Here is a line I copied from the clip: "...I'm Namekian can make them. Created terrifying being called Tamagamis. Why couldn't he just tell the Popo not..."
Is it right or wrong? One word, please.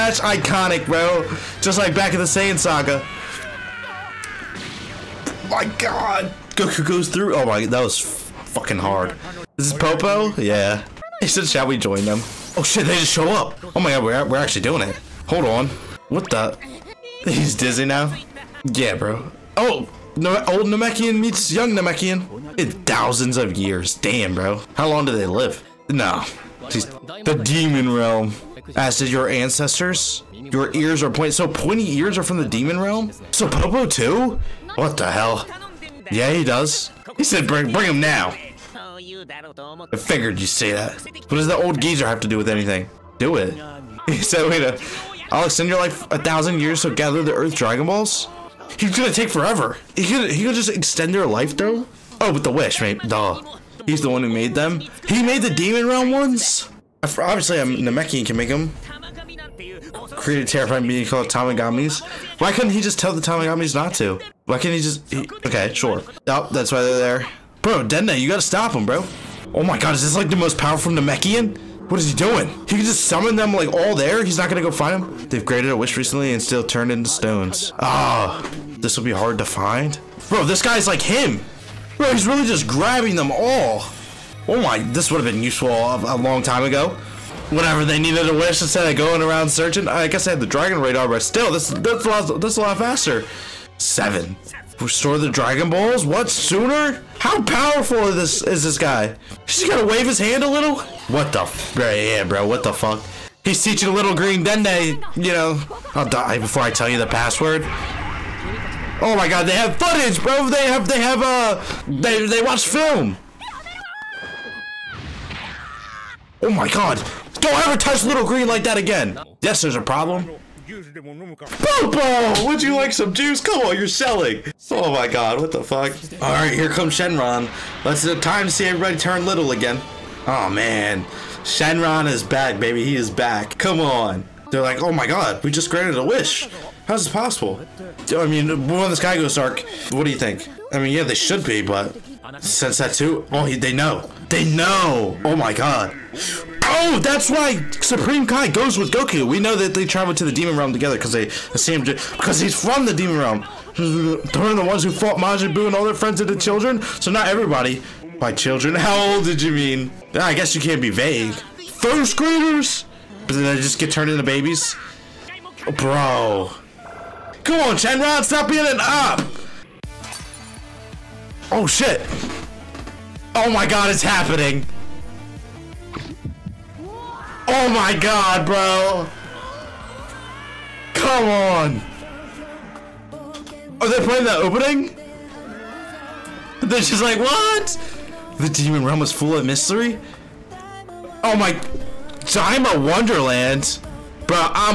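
wrong.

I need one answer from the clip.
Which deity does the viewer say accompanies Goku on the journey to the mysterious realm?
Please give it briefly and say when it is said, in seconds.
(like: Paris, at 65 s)
Supreme Kai, at 147 s.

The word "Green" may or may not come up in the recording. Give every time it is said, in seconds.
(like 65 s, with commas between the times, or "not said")
104 s, 118 s.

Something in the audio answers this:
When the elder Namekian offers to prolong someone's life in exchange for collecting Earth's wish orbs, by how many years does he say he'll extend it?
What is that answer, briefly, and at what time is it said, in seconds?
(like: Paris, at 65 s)
1000 years, at 46 s.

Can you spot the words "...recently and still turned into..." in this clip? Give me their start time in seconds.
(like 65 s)
75 s.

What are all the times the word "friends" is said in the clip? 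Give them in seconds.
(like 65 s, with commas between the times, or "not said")
155 s.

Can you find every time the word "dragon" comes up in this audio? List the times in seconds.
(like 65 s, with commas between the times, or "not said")
47 s, 90 s, 95 s.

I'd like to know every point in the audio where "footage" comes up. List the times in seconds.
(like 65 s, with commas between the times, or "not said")
109 s.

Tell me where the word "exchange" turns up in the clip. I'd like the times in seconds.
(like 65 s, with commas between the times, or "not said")
not said.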